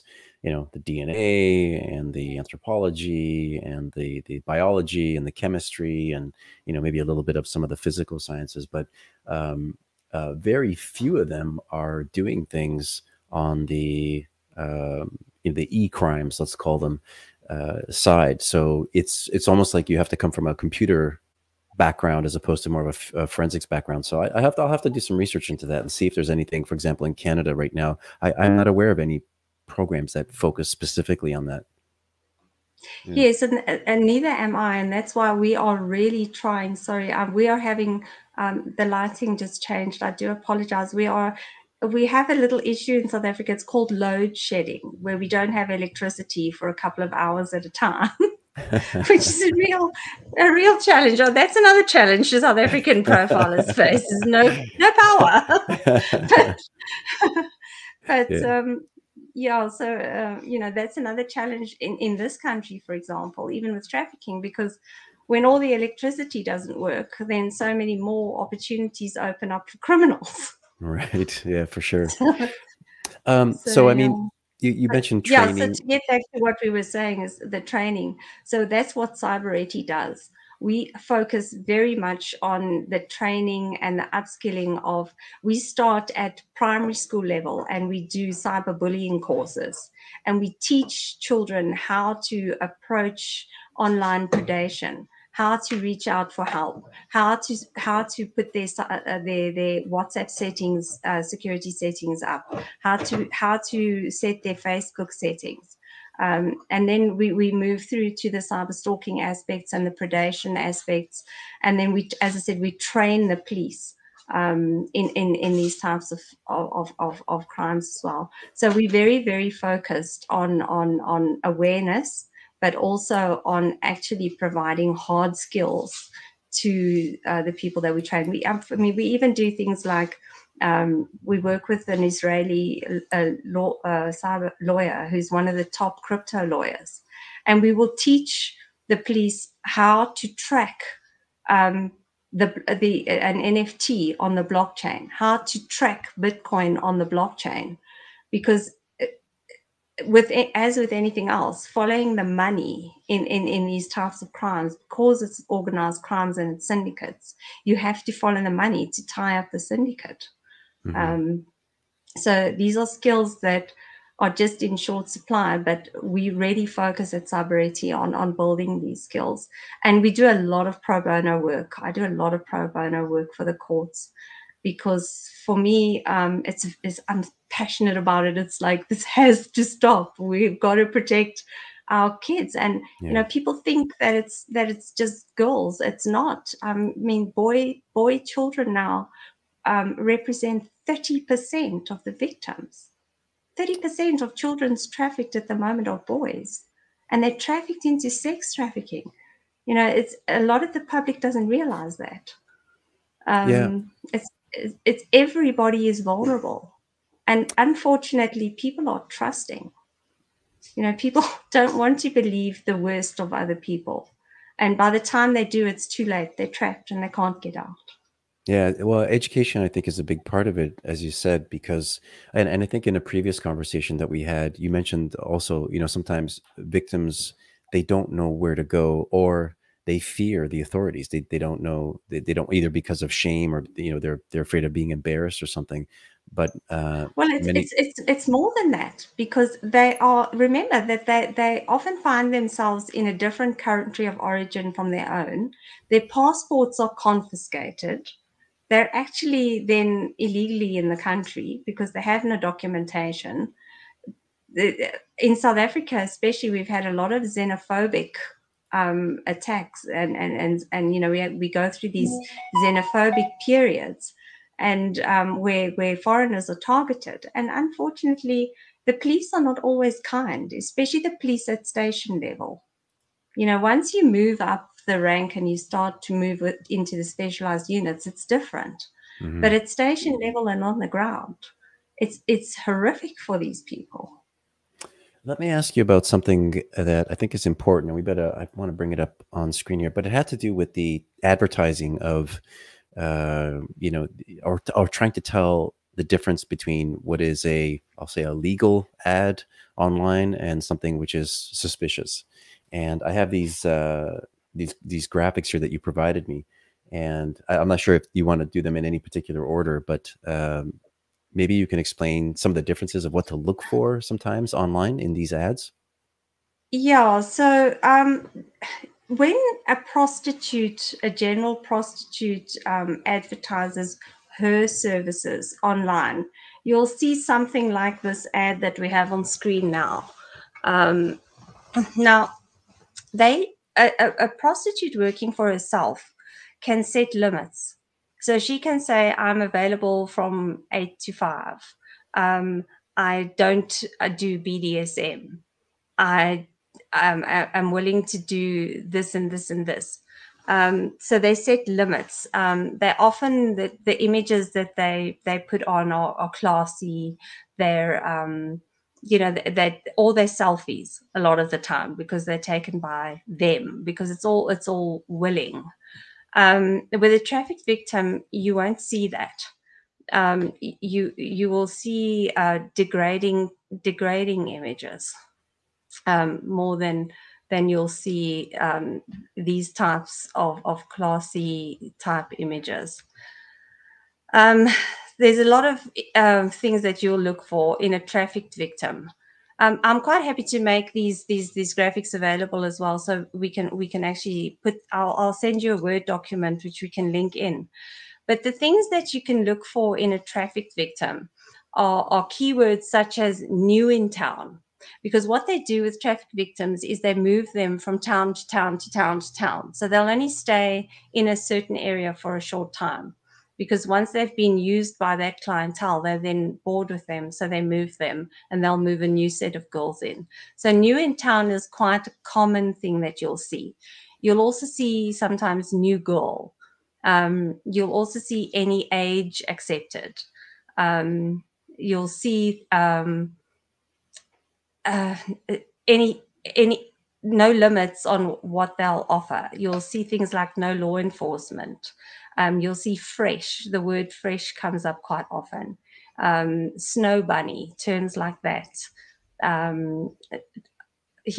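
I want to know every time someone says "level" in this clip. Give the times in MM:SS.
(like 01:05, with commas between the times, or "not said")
01:27, 04:32, 04:40.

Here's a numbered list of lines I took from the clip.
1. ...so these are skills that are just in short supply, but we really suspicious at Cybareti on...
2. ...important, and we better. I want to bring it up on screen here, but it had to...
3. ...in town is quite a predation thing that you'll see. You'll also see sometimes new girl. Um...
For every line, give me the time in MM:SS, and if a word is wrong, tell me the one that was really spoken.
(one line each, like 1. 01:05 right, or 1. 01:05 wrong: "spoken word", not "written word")
1. 02:42 wrong: "focus", not "suspicious"
2. 04:47 right
3. 07:00 wrong: "common", not "predation".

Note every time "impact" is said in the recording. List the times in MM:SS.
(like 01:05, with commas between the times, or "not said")
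not said.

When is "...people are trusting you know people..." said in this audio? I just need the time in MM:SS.
03:28.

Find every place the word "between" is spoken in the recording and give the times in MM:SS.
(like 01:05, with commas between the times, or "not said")
04:56.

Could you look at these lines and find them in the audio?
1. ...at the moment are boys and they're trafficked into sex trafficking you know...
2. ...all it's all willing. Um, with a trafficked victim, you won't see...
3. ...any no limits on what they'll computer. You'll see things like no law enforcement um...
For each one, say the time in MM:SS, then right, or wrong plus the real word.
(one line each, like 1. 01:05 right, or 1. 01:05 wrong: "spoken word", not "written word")
1. 03:15 right
2. 06:04 right
3. 07:16 wrong: "offer", not "computer".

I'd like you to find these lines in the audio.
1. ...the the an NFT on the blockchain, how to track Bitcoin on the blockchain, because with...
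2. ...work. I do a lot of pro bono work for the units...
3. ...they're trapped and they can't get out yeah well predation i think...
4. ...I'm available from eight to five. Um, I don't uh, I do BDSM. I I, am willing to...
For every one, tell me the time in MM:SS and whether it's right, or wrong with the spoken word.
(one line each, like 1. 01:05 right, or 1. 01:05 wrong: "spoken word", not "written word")
1. 02:22 right
2. 02:51 wrong: "courts", not "units"
3. 03:36 wrong: "education", not "predation"
4. 05:39 right.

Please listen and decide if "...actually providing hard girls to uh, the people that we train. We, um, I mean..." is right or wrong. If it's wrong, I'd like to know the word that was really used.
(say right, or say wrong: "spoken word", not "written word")
wrong: "skills", not "girls".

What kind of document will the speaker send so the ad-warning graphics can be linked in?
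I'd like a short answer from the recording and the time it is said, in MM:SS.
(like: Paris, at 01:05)
a Word document, at 06:35.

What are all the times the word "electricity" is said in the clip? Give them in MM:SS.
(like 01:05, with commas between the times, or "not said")
00:45, 01:05.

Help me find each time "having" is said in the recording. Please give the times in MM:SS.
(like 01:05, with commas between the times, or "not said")
00:37.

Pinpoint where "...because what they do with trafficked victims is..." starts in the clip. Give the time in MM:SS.
06:45.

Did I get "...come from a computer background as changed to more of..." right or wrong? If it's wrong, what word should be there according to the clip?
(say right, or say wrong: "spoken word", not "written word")
wrong: "opposed", not "changed".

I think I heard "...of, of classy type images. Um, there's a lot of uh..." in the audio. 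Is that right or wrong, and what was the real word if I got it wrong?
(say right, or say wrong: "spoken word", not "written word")
right.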